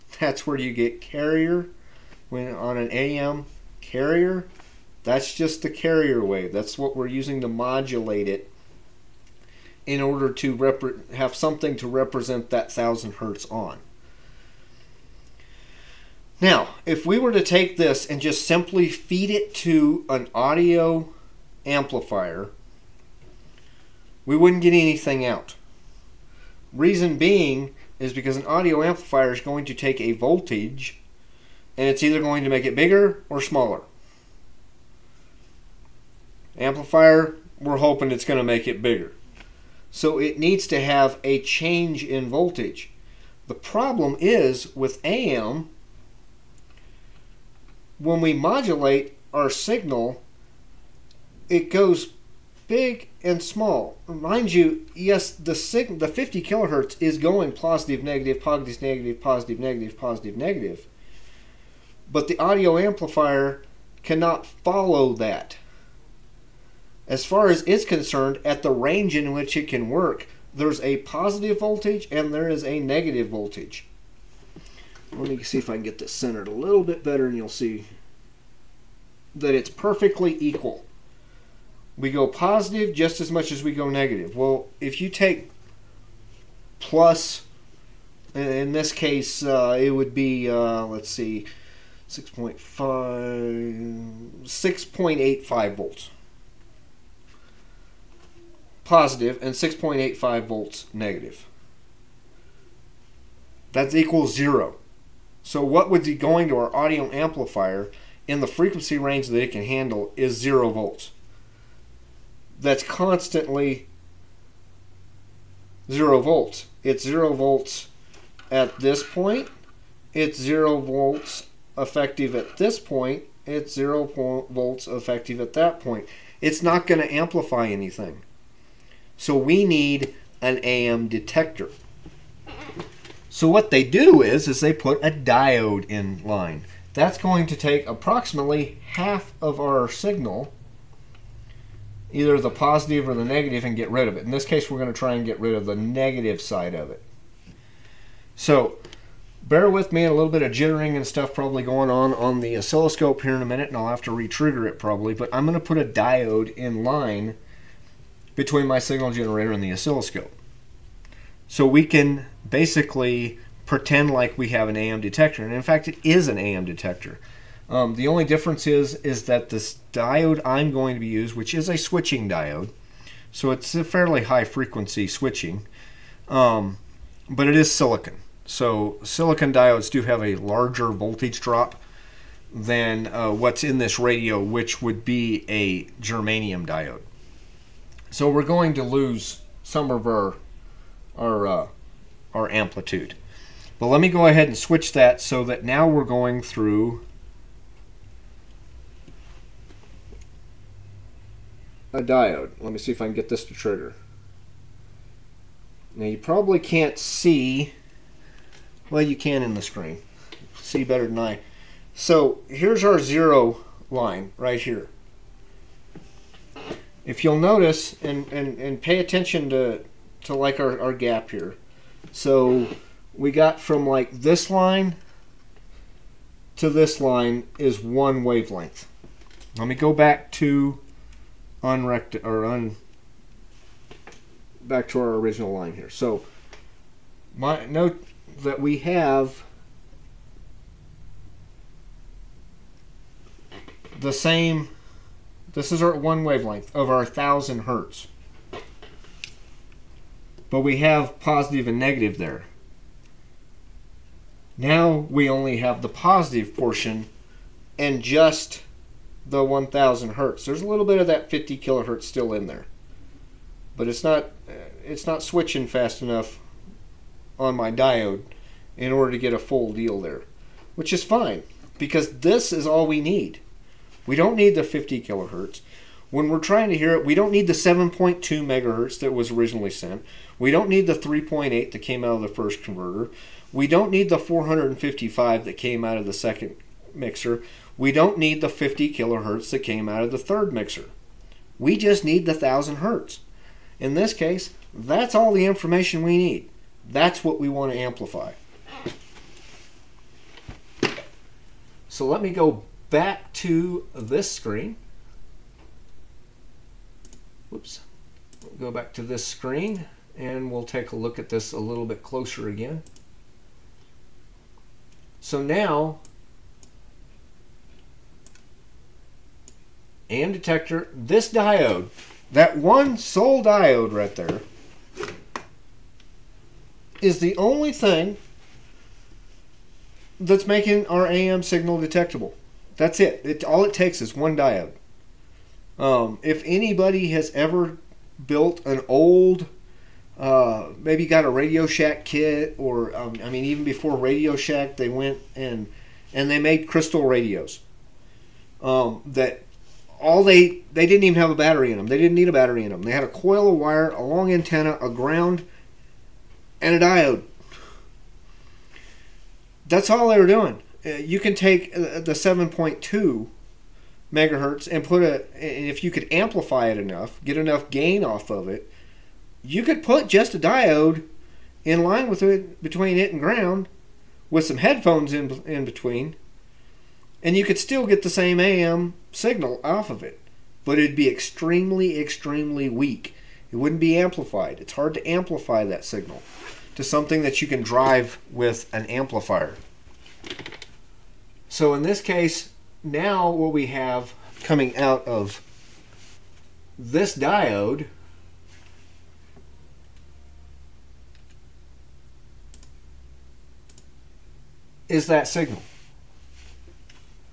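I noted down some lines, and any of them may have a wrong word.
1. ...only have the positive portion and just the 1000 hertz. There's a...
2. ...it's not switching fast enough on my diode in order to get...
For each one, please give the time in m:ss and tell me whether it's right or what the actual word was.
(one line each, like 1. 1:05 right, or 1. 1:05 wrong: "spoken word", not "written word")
1. 4:15 right
2. 4:24 right.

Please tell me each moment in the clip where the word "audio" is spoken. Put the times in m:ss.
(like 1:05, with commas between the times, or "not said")
0:20, 0:28, 1:02, 1:46.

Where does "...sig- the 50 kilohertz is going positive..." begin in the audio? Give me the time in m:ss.
0:55.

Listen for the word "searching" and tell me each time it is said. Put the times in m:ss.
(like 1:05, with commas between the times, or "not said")
not said.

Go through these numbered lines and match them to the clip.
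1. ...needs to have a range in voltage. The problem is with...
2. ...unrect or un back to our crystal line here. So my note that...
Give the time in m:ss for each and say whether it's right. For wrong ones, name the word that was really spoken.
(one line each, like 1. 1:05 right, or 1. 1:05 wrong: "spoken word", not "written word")
1. 0:40 wrong: "change", not "range"
2. 3:51 wrong: "original", not "crystal".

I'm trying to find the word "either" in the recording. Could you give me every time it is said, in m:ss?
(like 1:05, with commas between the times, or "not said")
0:32, 2:22.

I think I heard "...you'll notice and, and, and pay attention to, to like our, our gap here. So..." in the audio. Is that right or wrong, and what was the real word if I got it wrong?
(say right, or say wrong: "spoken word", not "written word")
right.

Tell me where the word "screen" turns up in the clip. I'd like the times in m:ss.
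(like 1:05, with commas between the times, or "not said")
3:29, 5:04, 5:09.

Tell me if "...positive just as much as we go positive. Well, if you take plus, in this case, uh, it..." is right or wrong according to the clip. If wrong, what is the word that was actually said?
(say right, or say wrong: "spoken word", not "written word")
wrong: "negative", not "positive".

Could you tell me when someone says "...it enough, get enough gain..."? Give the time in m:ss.
6:06.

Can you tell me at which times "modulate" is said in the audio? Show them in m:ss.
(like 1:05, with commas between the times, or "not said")
0:07, 0:48.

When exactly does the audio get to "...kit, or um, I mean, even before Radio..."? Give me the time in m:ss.
5:42.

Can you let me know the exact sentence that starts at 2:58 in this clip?
So silicon diodes do have a larger voltage drop than uh, what's in this radio, which would be a germanium diode.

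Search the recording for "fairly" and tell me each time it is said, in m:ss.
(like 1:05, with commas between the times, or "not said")
2:53.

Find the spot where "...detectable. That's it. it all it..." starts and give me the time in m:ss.
5:31.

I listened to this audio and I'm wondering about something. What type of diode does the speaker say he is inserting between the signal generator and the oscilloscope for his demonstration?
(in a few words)
switching diode.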